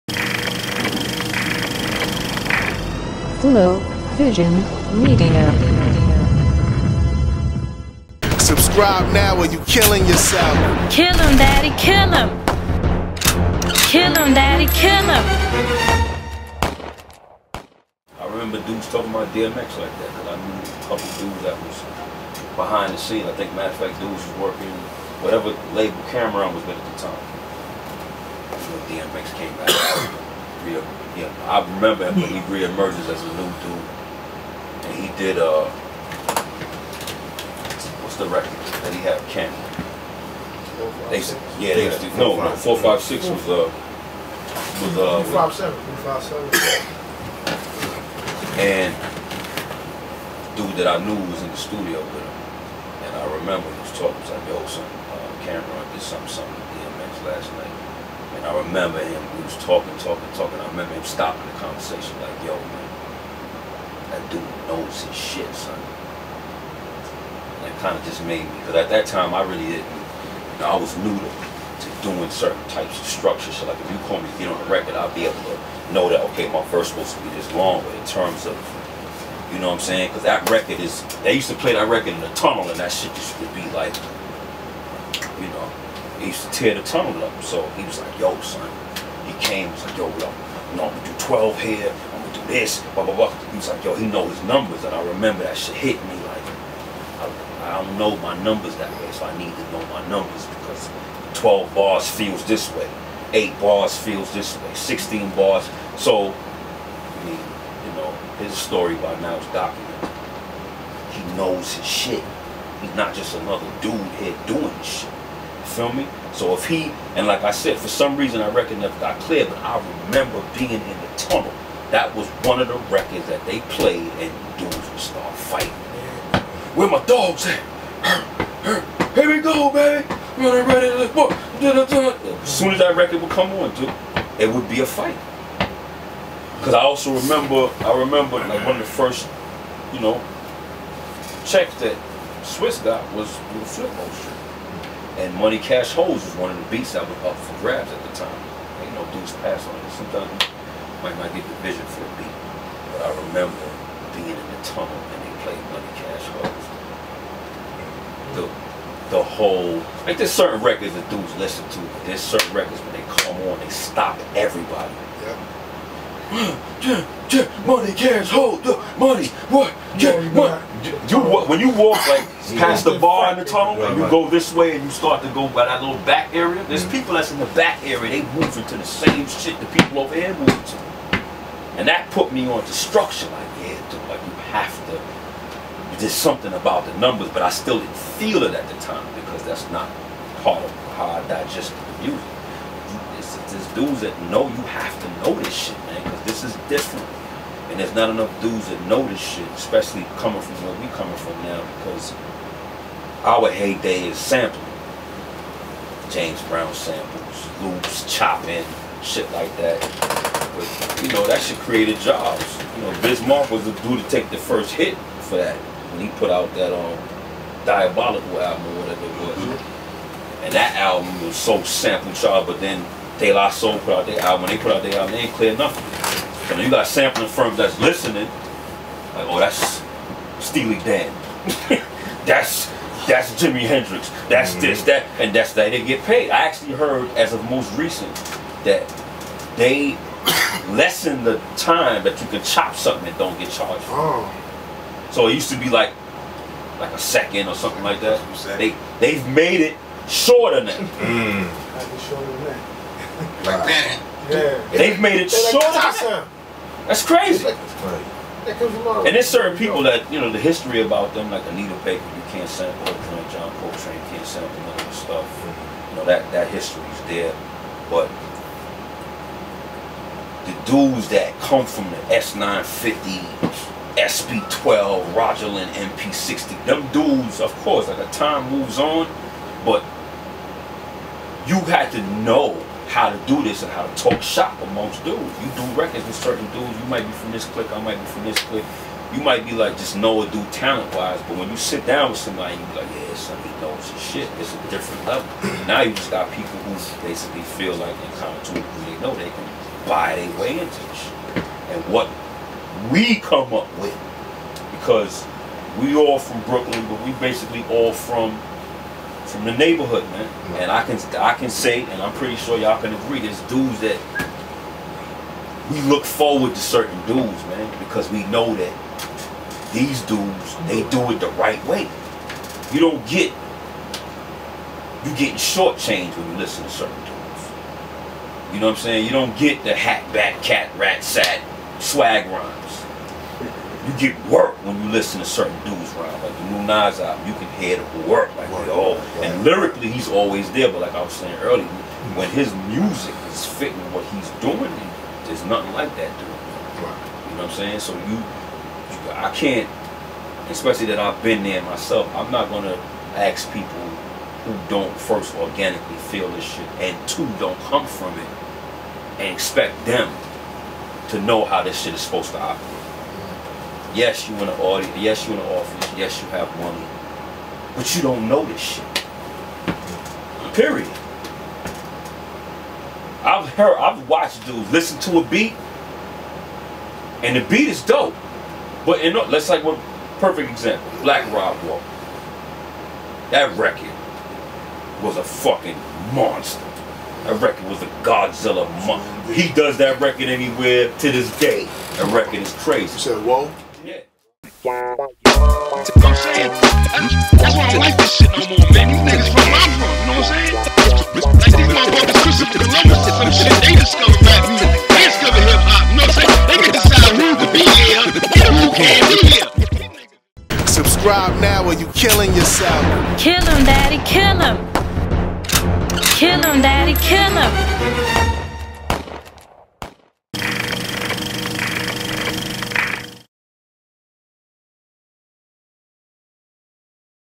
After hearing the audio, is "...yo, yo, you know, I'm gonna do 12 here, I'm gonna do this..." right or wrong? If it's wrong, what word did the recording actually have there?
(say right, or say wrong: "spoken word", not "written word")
right.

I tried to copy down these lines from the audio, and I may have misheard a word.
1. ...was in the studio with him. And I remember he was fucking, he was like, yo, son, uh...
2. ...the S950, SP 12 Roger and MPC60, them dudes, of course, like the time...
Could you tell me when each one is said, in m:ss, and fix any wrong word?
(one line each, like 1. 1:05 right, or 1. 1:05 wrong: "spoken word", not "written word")
1. 0:51 wrong: "talking", not "fucking"
2. 4:31 right.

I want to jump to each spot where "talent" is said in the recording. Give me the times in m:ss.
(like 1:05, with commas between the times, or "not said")
4:50.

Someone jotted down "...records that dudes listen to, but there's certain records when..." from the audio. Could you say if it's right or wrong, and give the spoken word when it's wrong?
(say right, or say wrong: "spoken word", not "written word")
right.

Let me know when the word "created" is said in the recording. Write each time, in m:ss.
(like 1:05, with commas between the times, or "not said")
3:31.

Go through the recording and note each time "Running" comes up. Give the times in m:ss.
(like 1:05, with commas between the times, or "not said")
2:10.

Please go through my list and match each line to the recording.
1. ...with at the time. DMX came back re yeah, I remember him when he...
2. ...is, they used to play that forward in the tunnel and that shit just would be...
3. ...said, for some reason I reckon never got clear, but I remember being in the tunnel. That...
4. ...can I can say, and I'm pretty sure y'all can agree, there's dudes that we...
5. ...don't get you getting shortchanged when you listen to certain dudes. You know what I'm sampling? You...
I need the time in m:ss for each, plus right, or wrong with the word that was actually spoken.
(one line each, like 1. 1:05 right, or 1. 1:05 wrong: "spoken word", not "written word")
1. 0:26 right
2. 1:20 wrong: "record", not "forward"
3. 1:57 right
4. 5:10 right
5. 5:22 wrong: "saying", not "sampling".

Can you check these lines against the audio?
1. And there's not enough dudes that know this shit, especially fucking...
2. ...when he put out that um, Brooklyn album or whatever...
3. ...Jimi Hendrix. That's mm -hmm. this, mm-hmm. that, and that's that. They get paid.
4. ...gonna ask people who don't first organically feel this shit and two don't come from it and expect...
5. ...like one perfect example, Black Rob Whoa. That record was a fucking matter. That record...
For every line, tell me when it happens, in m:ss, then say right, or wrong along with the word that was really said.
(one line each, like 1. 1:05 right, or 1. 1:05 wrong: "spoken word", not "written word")
1. 3:17 wrong: "coming", not "fucking"
2. 3:35 wrong: "Diabolical", not "Brooklyn"
3. 3:53 right
4. 5:52 right
5. 6:19 wrong: "monster", not "matter".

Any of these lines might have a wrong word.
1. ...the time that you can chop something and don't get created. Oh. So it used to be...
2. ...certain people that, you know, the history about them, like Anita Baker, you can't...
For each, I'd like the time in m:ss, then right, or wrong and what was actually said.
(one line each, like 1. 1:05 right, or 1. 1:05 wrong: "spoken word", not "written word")
1. 4:01 wrong: "charged", not "created"
2. 4:19 right.